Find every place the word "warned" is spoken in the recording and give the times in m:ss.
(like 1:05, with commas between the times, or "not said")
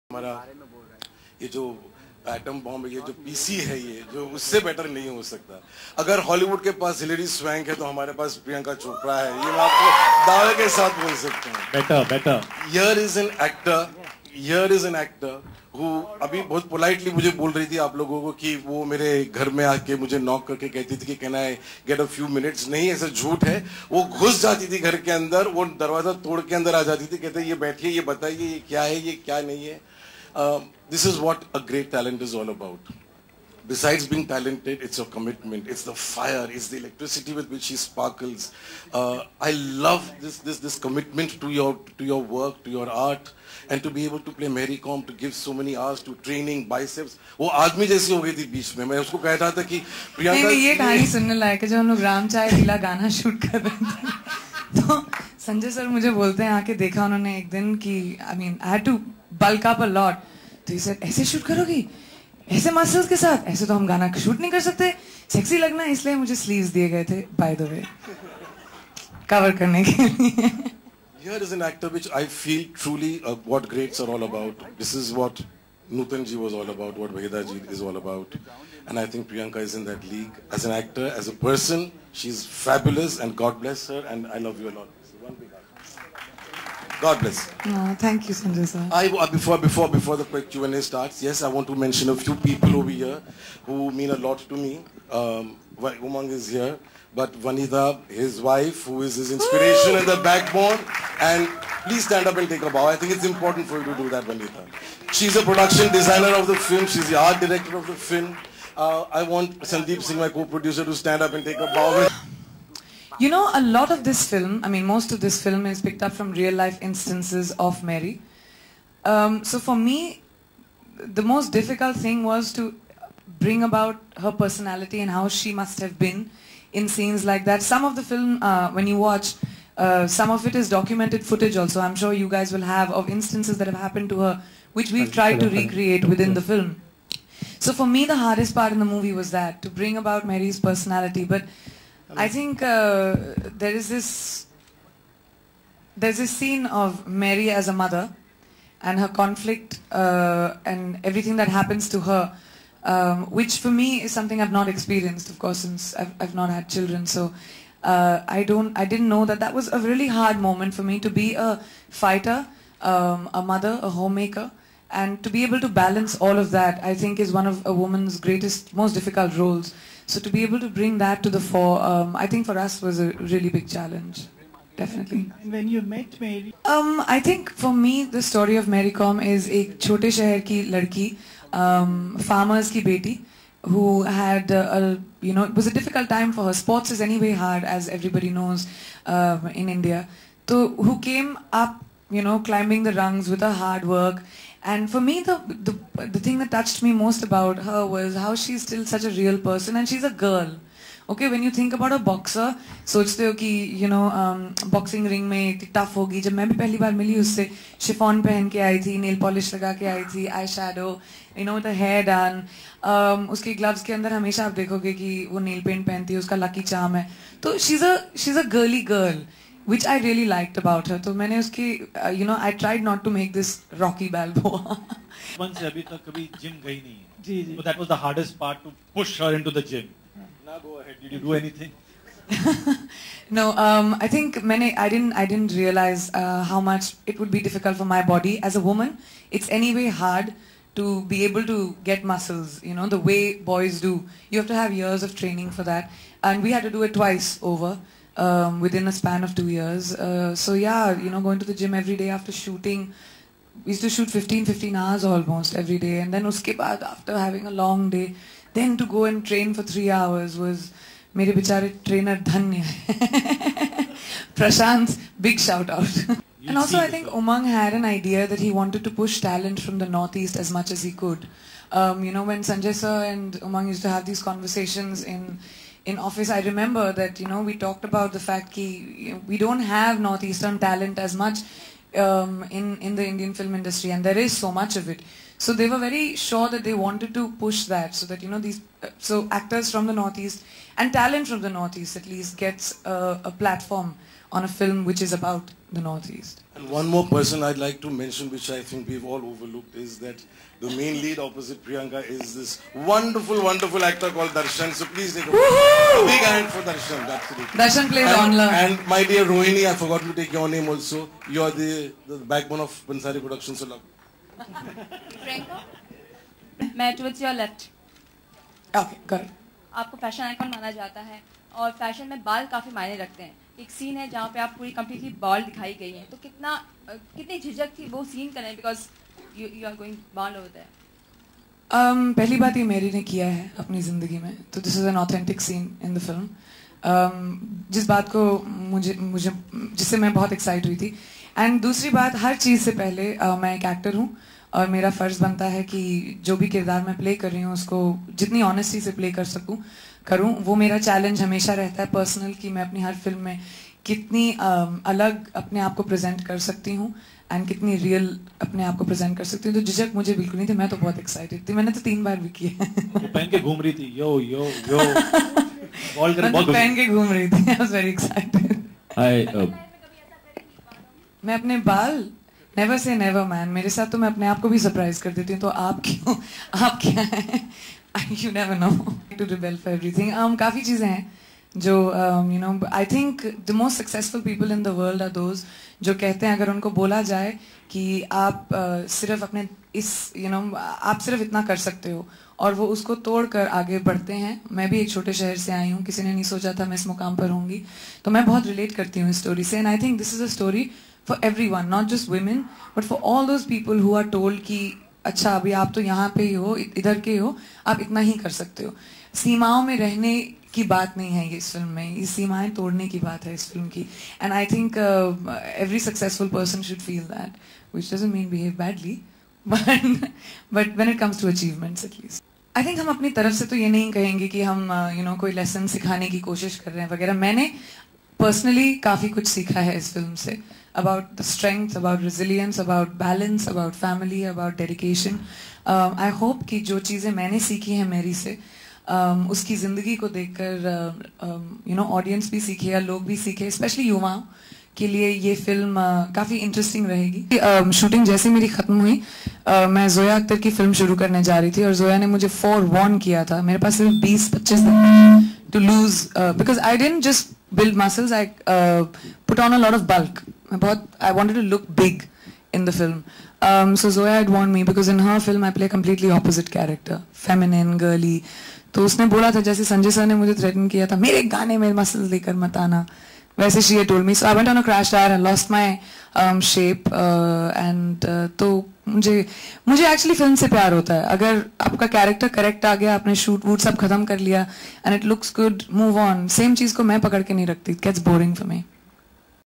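7:44.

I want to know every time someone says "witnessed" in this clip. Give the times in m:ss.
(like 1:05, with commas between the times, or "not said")
not said.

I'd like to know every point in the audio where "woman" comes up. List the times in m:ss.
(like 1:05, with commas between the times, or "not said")
2:47, 3:58.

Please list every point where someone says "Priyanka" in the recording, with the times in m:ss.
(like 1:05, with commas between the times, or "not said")
1:19, 5:01.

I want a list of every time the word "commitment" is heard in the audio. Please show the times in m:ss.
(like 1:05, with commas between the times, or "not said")
0:35, 0:40.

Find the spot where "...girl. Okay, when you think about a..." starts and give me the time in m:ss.
3:20.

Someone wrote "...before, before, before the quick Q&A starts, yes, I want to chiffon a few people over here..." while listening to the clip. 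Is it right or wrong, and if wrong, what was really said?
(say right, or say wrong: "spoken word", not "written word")
wrong: "mention", not "chiffon".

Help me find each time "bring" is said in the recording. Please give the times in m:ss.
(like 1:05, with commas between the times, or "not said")
2:03, 2:19, 2:50.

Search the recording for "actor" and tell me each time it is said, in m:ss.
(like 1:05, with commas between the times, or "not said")
1:11, 1:20, 4:49, 5:03.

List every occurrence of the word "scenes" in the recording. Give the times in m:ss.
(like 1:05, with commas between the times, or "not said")
2:06, 2:26.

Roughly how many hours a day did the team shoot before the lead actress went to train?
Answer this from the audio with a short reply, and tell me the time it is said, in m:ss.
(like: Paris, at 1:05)
15, at 4:14.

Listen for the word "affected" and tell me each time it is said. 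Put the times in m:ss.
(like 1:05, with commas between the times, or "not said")
not said.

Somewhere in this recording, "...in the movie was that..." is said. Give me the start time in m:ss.
2:18.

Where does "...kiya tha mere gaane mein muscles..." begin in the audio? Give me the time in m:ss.
7:50.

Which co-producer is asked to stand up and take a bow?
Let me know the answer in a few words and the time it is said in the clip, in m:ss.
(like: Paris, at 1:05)
Sandeep Singh, at 1:49.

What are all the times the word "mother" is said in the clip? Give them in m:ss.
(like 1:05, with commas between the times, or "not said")
2:27, 2:43.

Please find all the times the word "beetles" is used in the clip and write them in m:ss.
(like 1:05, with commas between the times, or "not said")
not said.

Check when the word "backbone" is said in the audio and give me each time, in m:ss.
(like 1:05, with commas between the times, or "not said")
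1:40, 5:12.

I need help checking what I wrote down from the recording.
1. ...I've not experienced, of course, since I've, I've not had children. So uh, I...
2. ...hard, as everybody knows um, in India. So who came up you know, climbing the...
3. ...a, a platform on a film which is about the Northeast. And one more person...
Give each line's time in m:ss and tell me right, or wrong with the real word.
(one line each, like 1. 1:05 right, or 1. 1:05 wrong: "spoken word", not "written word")
1. 2:34 right
2. 3:07 right
3. 4:52 right.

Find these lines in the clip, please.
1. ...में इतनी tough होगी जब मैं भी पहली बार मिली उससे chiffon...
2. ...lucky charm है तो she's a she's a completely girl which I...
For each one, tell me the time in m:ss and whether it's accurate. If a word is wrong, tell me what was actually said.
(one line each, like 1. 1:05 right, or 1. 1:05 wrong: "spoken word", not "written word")
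1. 3:25 right
2. 3:36 wrong: "girly", not "completely".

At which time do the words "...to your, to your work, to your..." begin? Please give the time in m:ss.
0:41.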